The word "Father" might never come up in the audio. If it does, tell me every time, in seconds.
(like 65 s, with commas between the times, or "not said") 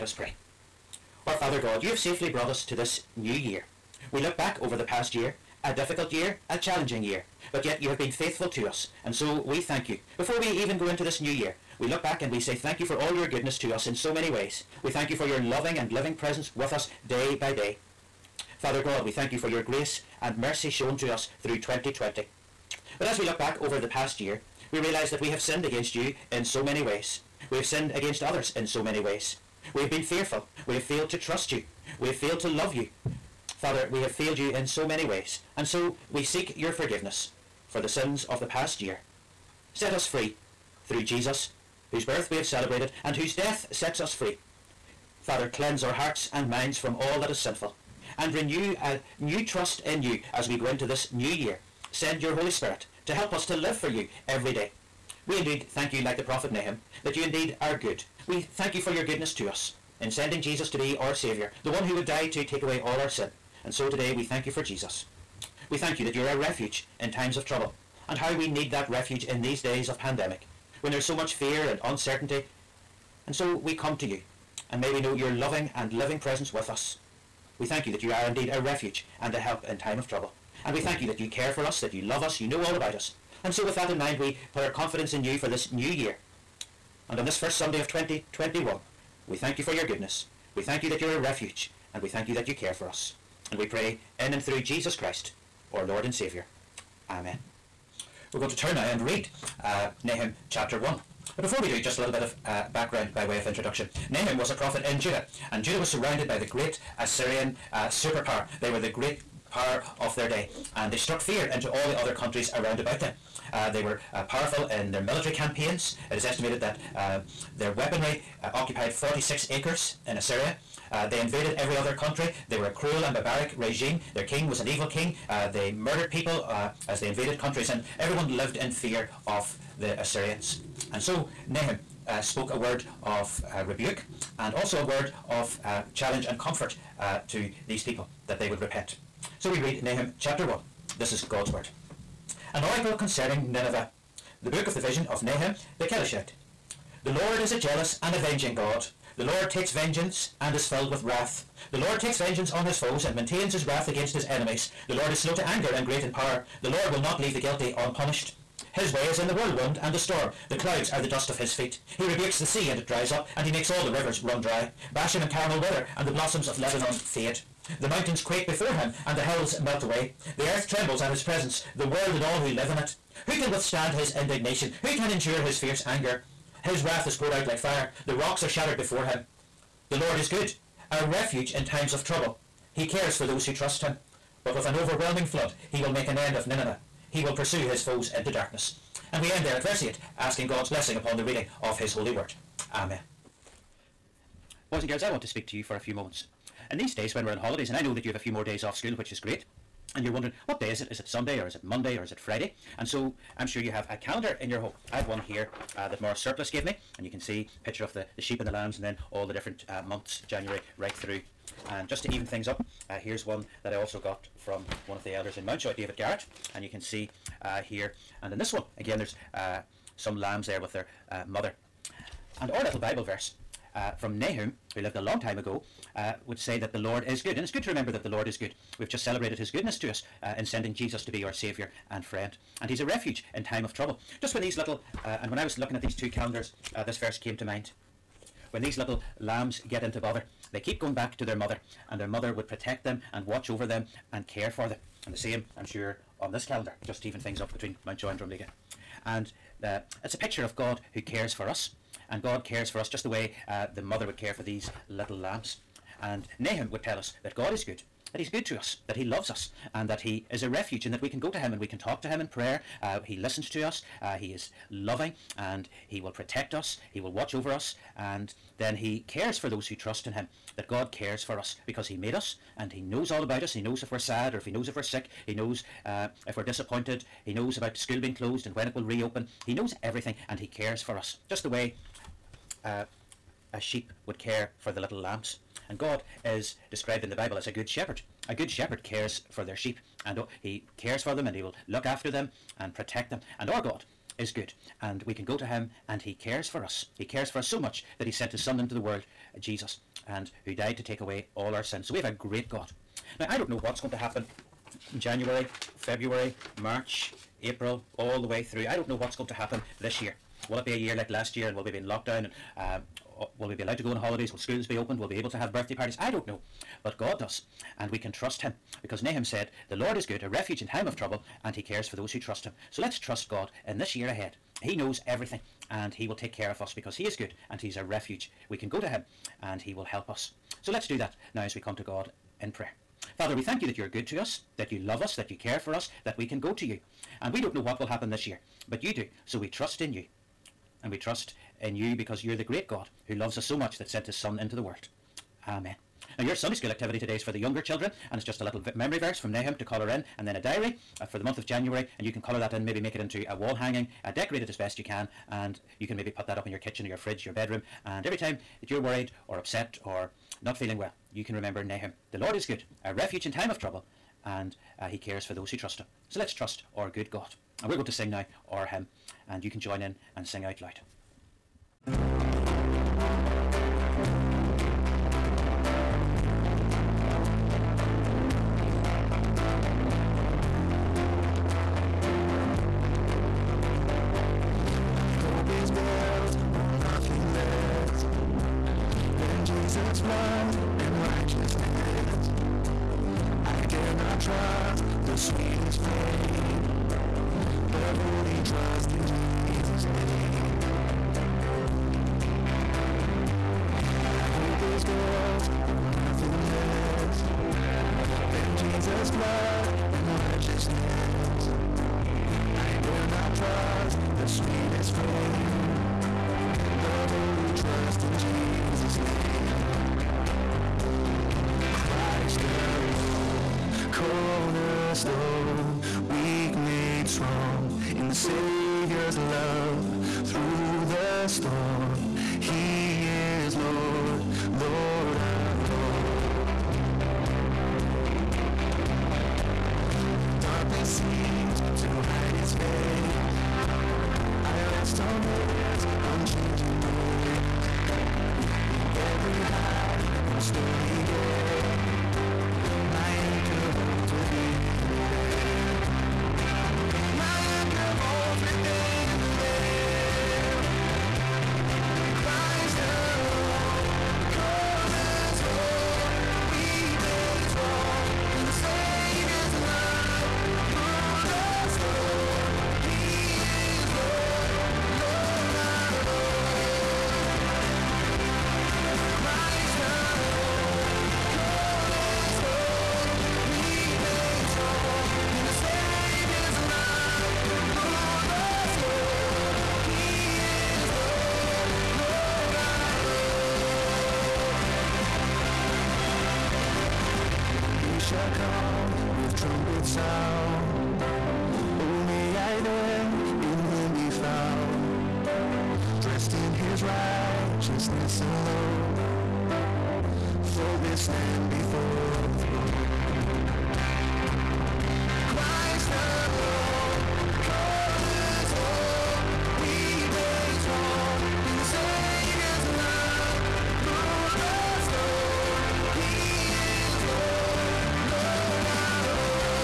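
1 s, 18 s, 33 s, 45 s, 333 s.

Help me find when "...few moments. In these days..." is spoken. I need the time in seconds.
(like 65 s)
195 s.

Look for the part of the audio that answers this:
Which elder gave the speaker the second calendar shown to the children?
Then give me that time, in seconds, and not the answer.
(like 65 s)
215 s.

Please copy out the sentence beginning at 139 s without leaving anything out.
So we read Nahum chapter 1 this is God's word.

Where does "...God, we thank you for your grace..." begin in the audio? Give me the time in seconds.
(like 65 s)
18 s.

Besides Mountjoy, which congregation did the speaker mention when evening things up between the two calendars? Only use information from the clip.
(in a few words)
Drumlegagh.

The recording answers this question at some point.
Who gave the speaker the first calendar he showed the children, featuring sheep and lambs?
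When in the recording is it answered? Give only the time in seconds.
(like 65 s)
206 s.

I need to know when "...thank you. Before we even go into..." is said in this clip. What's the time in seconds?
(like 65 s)
9 s.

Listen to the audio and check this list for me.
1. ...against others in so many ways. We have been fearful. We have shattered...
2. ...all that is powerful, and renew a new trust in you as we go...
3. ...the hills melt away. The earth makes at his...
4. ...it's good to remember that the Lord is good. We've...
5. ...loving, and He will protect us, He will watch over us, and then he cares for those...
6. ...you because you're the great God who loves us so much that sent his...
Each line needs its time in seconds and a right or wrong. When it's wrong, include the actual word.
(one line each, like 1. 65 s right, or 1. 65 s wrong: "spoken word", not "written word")
1. 27 s wrong: "failed", not "shattered"
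2. 46 s wrong: "sinful", not "powerful"
3. 169 s wrong: "trembles", not "makes"
4. 227 s right
5. 264 s right
6. 341 s right.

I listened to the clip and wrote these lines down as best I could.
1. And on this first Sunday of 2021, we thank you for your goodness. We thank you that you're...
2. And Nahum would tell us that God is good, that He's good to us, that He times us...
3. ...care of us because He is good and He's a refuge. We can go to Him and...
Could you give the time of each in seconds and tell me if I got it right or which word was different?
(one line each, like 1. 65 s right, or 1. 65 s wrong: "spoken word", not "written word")
1. 87 s right
2. 256 s wrong: "loves", not "times"
3. 326 s right.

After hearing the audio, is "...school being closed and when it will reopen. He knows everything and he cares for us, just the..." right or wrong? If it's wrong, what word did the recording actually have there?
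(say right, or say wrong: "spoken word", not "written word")
right.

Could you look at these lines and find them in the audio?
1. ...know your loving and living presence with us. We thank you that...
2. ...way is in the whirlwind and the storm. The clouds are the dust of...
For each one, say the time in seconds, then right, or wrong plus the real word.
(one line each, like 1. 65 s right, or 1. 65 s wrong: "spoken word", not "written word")
1. 74 s right
2. 158 s right.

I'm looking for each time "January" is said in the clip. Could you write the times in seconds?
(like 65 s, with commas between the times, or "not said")
210 s, 305 s, 351 s.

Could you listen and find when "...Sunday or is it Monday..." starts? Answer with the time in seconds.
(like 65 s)
201 s.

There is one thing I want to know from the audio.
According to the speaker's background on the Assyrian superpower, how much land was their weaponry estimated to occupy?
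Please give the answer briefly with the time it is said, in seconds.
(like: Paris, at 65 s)
46 acres, at 118 s.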